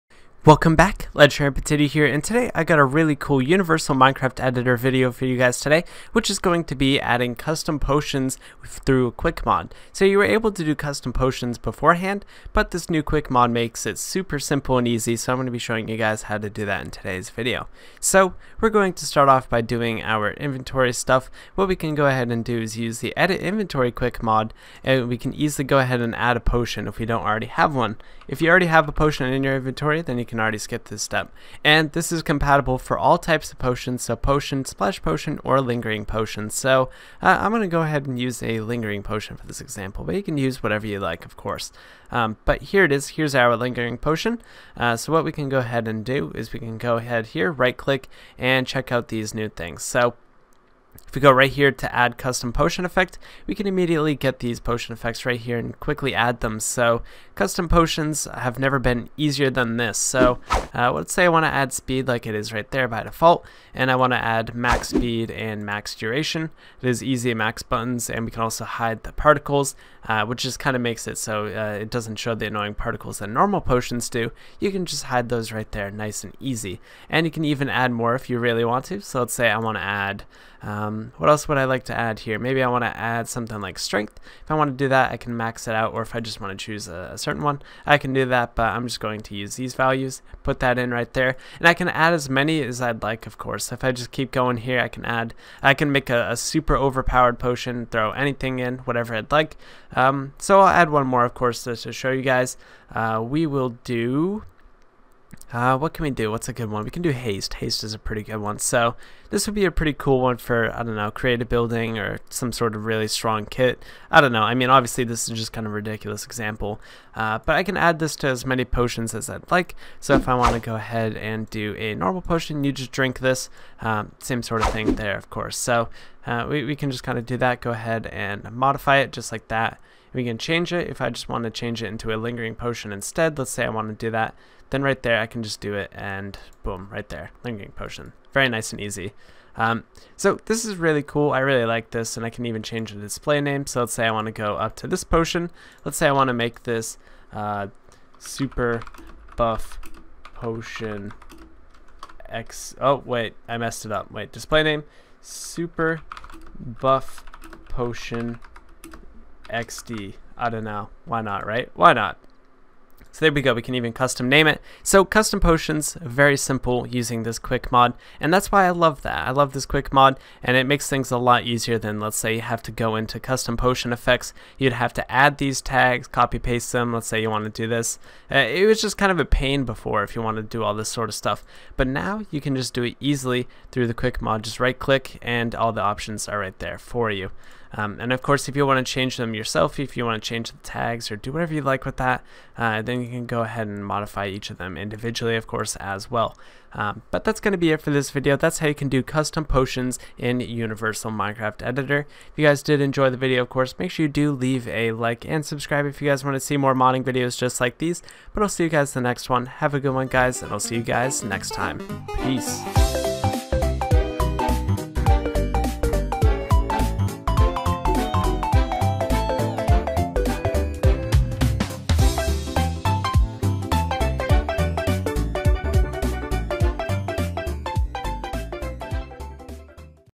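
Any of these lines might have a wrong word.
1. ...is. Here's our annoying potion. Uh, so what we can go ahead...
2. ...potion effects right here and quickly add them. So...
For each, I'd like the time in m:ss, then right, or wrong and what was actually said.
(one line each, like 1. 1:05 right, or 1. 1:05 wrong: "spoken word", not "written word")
1. 0:42 wrong: "lingering", not "annoying"
2. 0:54 right.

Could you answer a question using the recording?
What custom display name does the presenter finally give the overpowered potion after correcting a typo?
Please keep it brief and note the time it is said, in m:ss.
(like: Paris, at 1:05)
Super buff potion XD, at 2:35.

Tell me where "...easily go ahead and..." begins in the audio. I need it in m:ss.
0:25.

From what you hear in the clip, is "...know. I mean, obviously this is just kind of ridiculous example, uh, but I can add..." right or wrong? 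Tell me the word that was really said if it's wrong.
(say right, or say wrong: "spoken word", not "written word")
right.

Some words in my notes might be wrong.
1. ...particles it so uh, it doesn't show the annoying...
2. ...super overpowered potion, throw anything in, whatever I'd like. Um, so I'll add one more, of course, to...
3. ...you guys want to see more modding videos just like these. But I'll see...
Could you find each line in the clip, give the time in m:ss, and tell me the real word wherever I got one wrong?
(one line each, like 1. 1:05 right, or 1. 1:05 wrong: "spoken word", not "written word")
1. 1:10 wrong: "makes", not "particles"
2. 1:36 right
3. 3:26 right.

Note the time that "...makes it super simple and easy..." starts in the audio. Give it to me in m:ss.
0:13.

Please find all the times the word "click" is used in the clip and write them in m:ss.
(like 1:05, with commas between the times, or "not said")
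0:47, 3:04.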